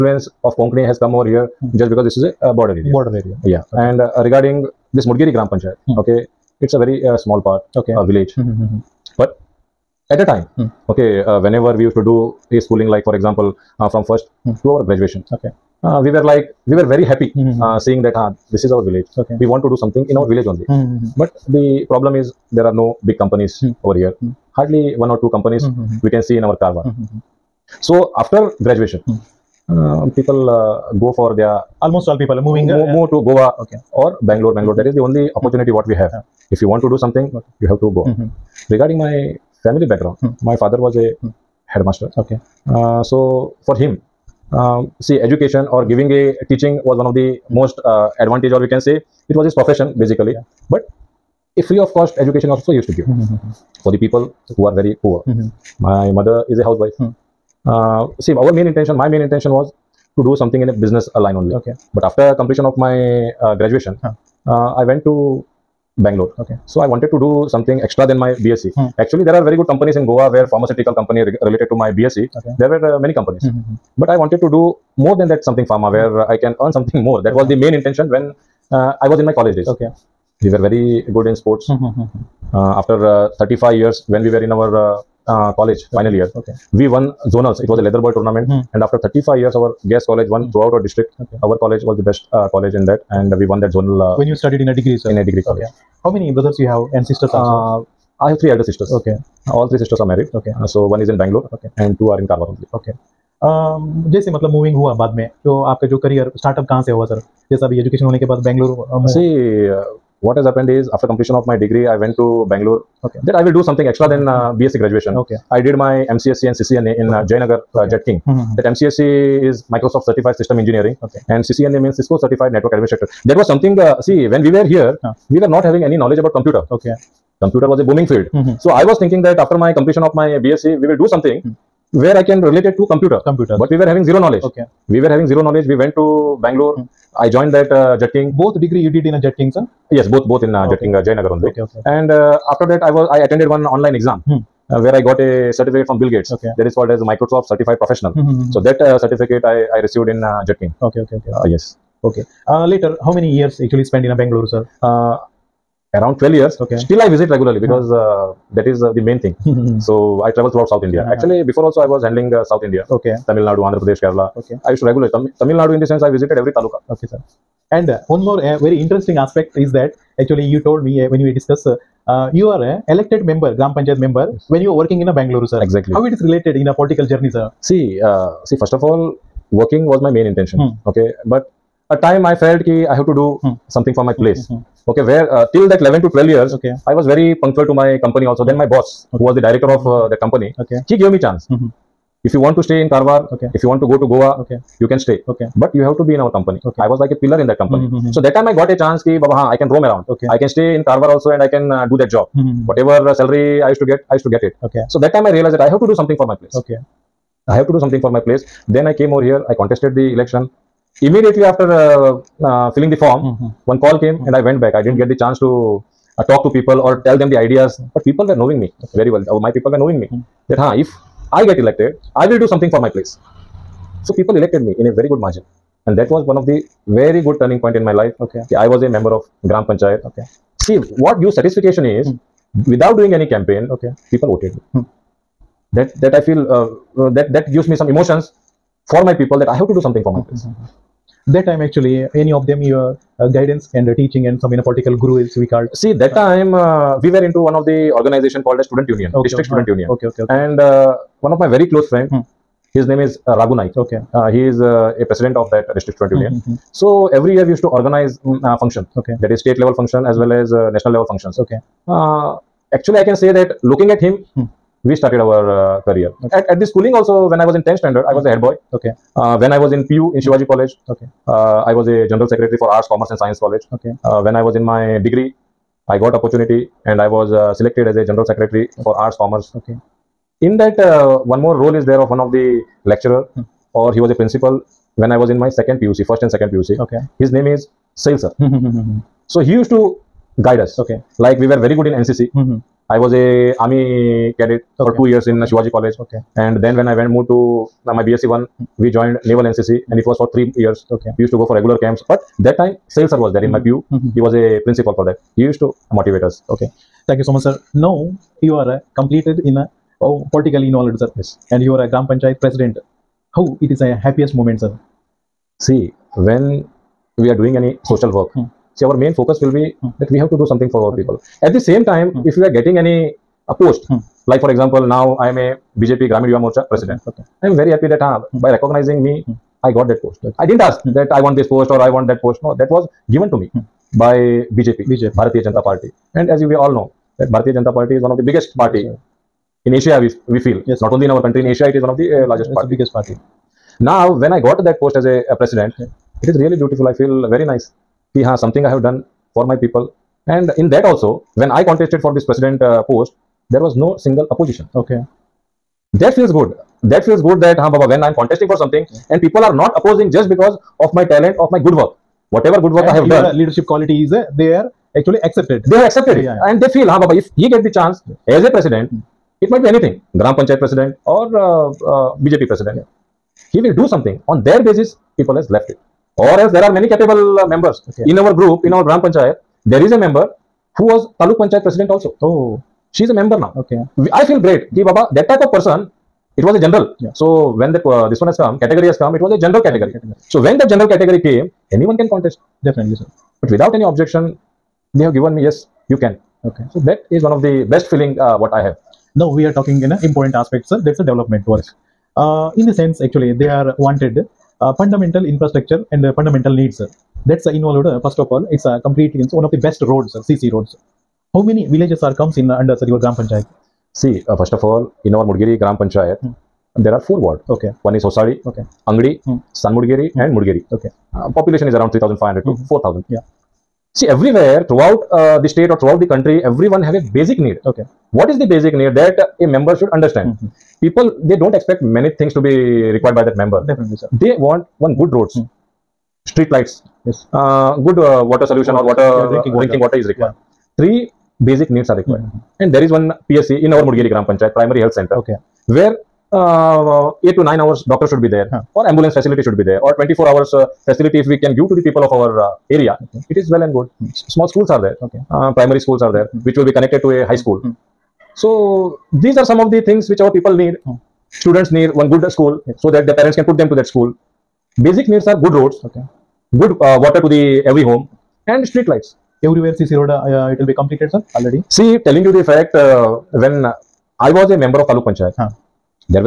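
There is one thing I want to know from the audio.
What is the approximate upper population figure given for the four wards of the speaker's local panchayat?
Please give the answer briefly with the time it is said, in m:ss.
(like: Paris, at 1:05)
4,000, at 7:02.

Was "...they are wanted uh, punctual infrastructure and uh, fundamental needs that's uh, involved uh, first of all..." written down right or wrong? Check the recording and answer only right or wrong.
wrong.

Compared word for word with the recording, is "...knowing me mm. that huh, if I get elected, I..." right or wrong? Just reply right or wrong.
right.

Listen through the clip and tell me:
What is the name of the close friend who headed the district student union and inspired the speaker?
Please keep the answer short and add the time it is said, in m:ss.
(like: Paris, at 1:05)
Raghu Naik, at 4:13.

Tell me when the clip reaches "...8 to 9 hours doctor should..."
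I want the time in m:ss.
7:27.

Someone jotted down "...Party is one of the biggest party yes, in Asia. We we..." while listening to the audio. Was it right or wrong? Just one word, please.
right.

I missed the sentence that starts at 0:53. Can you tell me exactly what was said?
for the people who are very poor.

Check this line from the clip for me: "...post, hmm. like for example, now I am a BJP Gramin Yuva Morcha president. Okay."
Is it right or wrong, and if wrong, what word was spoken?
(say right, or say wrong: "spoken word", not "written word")
right.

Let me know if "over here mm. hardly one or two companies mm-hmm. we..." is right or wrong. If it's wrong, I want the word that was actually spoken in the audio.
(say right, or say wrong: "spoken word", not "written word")
right.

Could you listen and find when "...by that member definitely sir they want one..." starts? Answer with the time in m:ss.
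7:13.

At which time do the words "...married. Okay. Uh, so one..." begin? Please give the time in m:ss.
1:40.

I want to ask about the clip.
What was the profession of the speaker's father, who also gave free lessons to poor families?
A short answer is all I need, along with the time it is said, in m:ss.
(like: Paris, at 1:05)
Headmaster, at 0:41.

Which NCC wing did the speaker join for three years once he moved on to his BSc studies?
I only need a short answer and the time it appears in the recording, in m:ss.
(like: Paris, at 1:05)
Naval NCC, at 4:59.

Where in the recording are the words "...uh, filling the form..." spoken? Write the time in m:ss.
3:32.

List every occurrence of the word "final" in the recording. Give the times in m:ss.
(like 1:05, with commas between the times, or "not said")
1:25.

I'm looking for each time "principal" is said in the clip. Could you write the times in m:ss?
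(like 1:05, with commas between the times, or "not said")
4:44, 5:04.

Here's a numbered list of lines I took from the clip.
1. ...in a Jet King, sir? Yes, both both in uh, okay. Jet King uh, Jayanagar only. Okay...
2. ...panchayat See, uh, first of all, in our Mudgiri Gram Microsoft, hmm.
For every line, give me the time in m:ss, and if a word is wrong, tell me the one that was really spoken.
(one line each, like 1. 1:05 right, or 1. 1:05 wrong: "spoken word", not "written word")
1. 2:19 right
2. 6:53 wrong: "Panchayat", not "Microsoft".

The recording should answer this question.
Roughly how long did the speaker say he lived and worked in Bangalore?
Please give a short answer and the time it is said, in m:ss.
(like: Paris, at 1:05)
Around 12 years, at 2:35.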